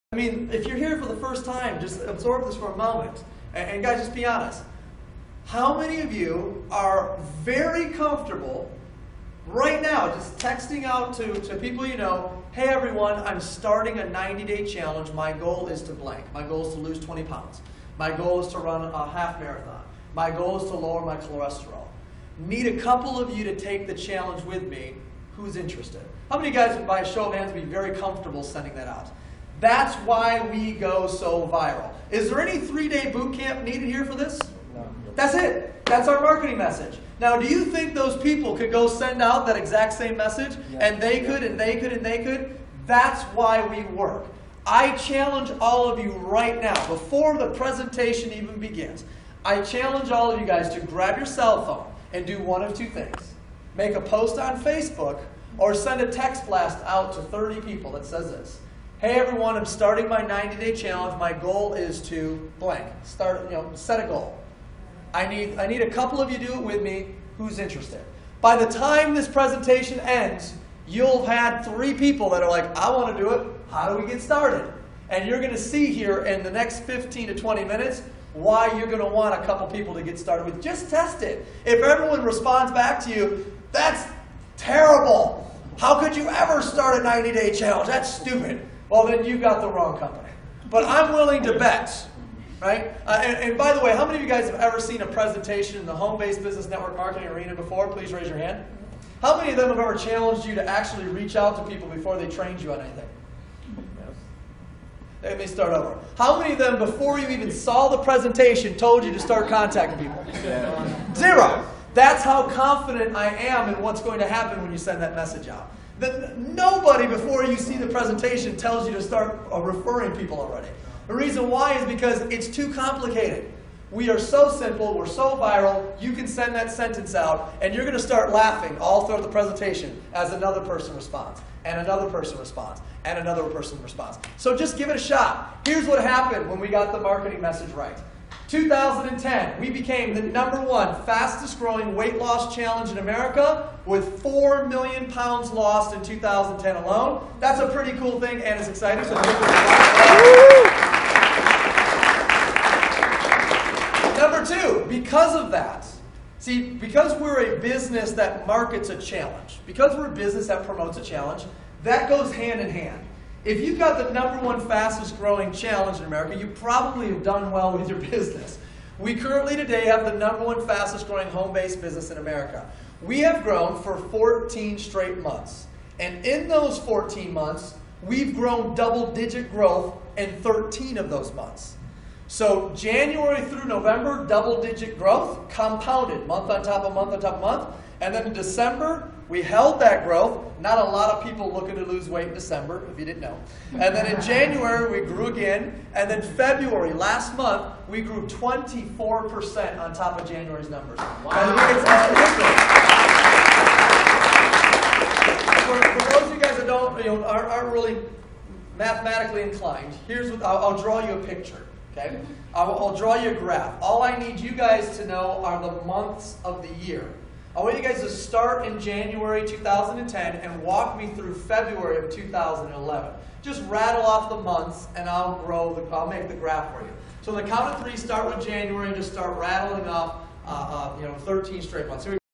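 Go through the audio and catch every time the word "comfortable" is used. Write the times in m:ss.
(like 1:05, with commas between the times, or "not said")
0:07, 0:27.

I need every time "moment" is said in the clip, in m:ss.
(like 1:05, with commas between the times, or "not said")
0:02.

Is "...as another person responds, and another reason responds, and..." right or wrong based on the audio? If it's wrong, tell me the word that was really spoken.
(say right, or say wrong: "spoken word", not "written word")
wrong: "person", not "reason".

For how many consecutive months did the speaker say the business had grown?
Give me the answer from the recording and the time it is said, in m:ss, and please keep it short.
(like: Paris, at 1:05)
14, at 2:53.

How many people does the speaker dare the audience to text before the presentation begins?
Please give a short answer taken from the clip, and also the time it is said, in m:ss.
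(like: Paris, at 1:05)
30, at 0:57.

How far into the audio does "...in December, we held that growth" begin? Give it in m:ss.
3:08.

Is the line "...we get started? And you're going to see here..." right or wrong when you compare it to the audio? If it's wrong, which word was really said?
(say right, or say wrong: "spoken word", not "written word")
right.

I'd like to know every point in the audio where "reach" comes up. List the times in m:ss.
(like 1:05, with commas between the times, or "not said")
1:41.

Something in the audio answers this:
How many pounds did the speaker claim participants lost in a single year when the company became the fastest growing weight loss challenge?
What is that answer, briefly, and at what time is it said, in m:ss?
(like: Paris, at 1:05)
4 million, at 2:24.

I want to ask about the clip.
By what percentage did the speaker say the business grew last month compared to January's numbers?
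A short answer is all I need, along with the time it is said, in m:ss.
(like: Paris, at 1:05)
24%, at 3:18.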